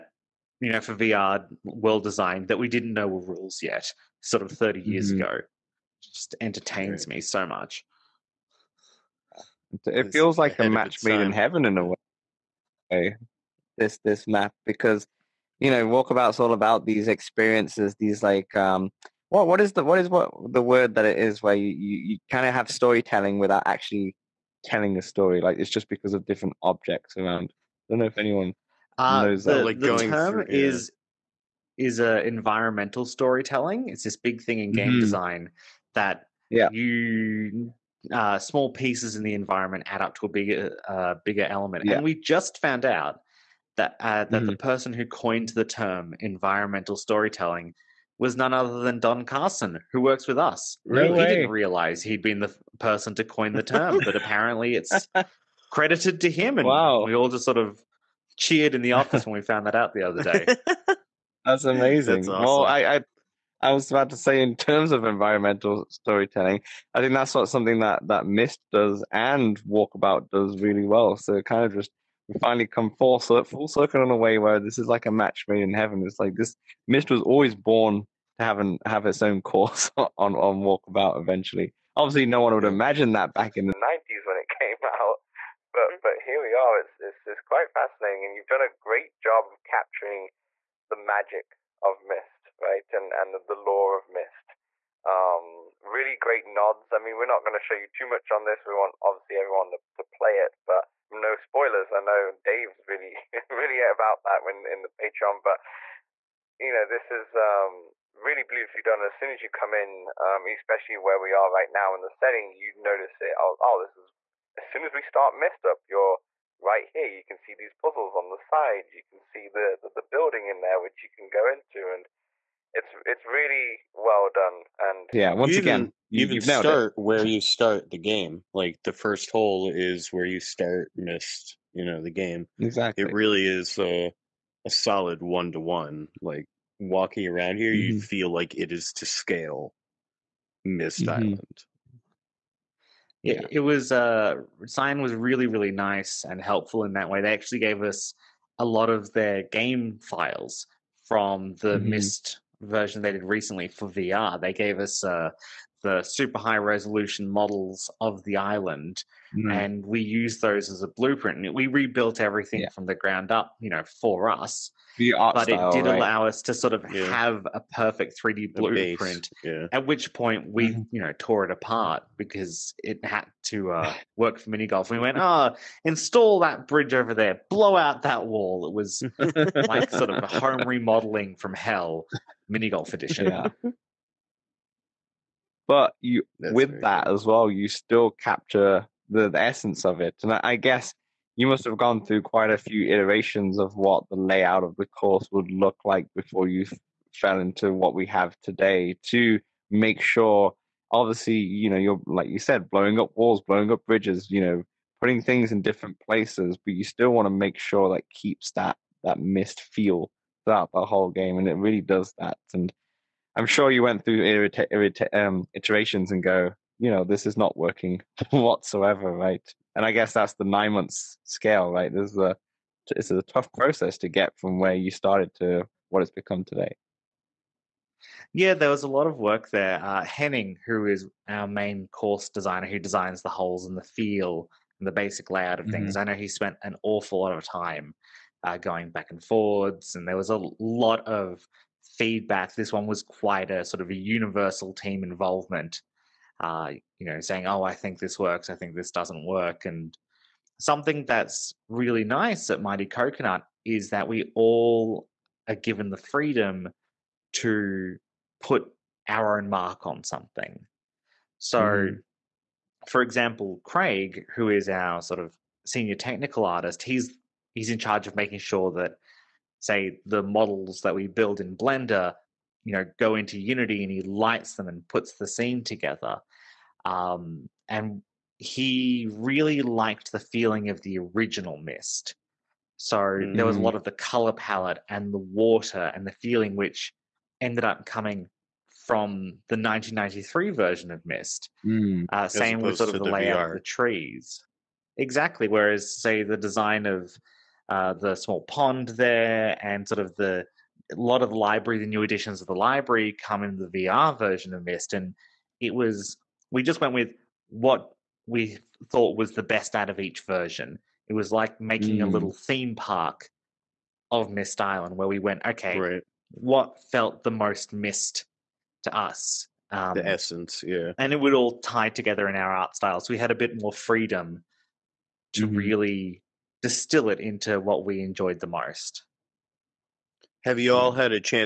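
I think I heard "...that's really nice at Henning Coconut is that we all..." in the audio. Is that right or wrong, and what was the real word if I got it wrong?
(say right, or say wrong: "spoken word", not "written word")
wrong: "Mighty", not "Henning".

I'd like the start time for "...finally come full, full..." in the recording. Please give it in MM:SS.
01:12.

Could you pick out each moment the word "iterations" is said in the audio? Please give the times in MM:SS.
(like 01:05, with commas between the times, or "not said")
03:12, 03:35.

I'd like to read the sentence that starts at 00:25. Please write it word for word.
Like it's just because of different objects around.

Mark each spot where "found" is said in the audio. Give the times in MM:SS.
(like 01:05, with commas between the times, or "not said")
00:42, 00:59.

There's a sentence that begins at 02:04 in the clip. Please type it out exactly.
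And yeah, once again, you, even start it.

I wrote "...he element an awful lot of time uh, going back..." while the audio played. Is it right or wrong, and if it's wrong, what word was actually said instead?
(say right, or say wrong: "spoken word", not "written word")
wrong: "spent", not "element".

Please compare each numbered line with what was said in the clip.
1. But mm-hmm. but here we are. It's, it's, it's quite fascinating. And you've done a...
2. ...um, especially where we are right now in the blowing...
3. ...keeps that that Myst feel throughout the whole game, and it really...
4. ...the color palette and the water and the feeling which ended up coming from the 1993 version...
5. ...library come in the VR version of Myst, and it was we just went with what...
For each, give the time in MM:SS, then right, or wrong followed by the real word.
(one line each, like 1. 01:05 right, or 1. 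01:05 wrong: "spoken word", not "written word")
1. 01:25 right
2. 01:50 wrong: "setting", not "blowing"
3. 03:28 right
4. 04:43 right
5. 05:02 right.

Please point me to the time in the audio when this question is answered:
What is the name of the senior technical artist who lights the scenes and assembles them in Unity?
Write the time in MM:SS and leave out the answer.
04:23.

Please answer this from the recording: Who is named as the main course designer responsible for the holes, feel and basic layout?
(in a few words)
Henning.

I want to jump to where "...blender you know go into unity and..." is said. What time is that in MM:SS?
04:31.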